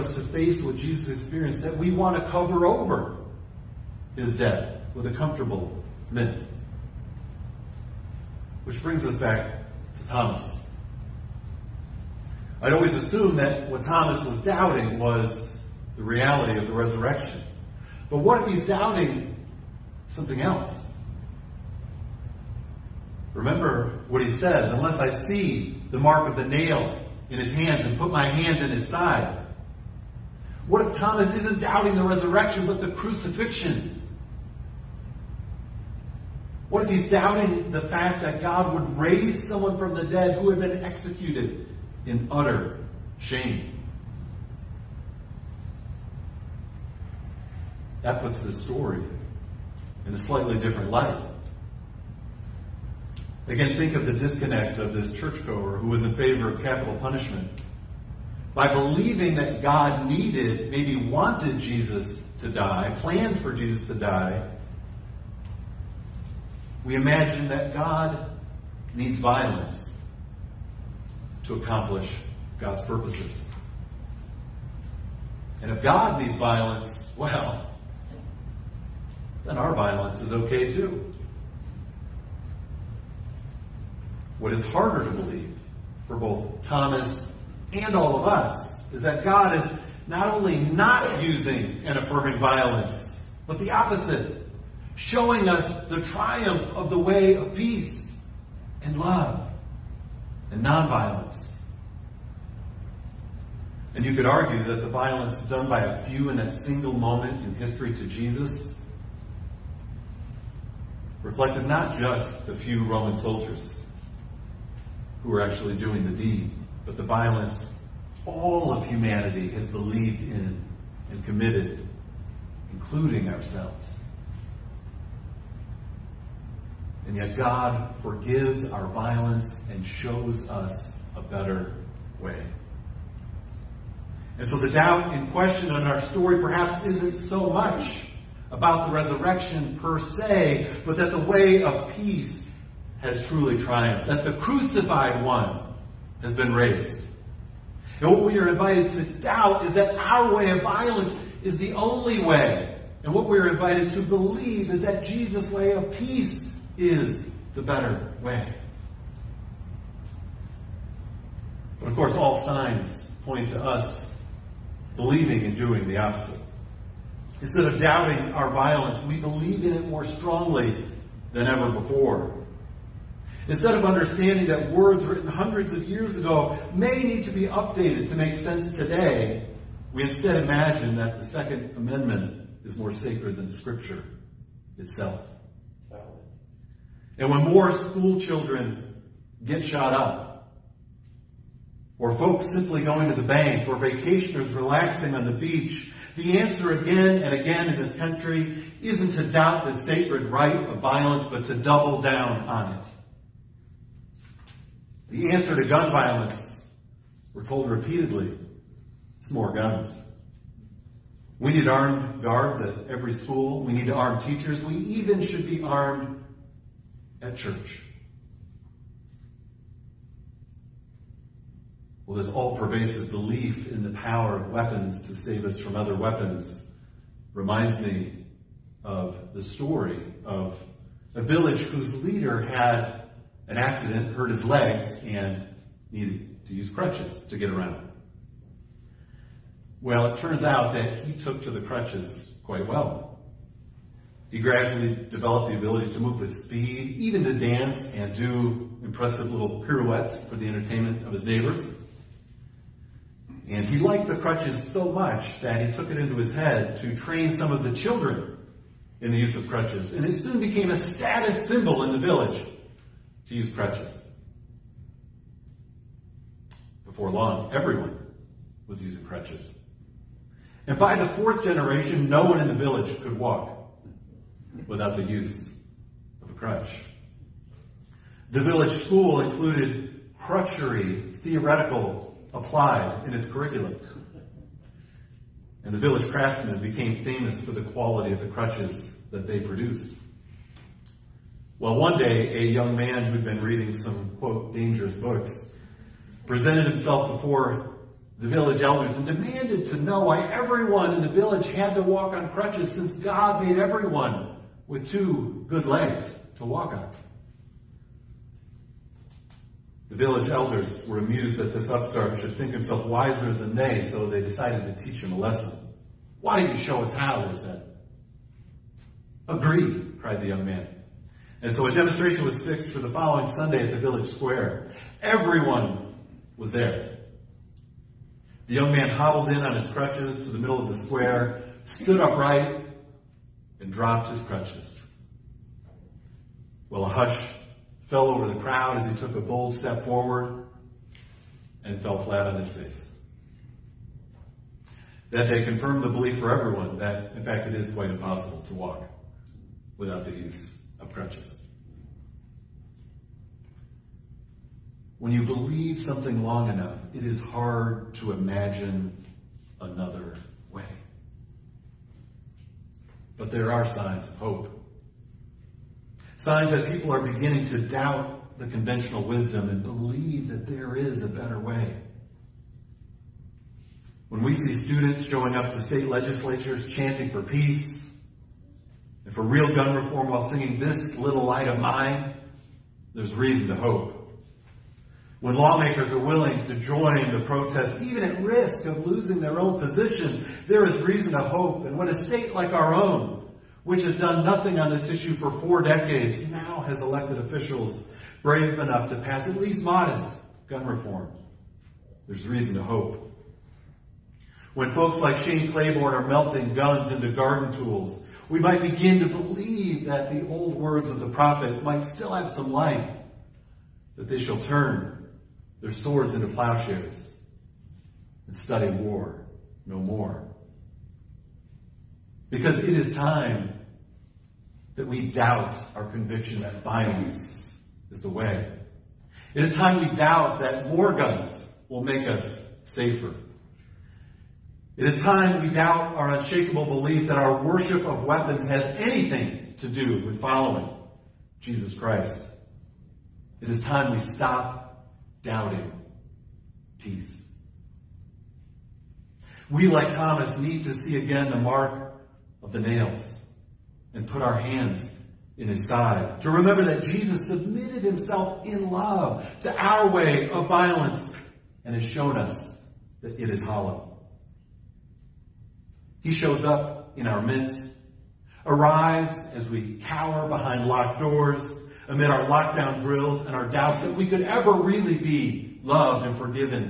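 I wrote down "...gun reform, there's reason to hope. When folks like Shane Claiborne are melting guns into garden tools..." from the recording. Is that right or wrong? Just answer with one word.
right.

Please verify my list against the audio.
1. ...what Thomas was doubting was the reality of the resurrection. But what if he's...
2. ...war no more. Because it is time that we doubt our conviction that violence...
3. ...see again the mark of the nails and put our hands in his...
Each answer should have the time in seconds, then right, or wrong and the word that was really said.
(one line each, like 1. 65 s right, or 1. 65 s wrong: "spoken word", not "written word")
1. 13 s right
2. 418 s right
3. 450 s right.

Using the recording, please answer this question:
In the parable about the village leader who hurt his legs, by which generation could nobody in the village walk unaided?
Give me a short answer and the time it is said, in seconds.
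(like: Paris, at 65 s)
fourth, at 271 s.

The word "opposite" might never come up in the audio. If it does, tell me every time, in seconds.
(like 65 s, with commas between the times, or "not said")
93 s, 165 s.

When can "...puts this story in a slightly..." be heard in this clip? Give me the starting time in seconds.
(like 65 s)
48 s.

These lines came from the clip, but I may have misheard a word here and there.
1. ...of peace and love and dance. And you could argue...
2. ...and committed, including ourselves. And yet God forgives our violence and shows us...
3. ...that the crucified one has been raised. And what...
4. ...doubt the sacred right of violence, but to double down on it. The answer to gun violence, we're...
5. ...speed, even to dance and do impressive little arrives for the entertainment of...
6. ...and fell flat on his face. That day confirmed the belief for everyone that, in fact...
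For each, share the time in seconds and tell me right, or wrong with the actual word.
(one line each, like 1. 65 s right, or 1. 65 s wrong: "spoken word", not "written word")
1. 97 s wrong: "nonviolence", not "dance"
2. 121 s right
3. 144 s right
4. 199 s right
5. 246 s wrong: "pirouettes", not "arrives"
6. 341 s right.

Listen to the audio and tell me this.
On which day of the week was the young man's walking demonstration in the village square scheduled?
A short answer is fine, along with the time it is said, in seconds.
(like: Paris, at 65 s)
Sunday, at 323 s.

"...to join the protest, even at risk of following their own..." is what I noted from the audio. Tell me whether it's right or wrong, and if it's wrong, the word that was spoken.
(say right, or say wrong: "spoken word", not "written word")
wrong: "losing", not "following".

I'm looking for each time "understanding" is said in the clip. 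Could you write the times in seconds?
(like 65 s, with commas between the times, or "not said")
173 s.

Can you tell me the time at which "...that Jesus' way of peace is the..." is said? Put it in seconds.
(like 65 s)
154 s.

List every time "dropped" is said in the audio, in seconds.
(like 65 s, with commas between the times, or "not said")
333 s.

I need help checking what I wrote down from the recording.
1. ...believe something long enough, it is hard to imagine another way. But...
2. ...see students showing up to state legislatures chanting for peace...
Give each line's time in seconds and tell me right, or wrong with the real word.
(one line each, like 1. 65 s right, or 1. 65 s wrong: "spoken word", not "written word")
1. 355 s right
2. 374 s right.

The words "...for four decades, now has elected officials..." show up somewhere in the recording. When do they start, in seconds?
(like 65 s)
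395 s.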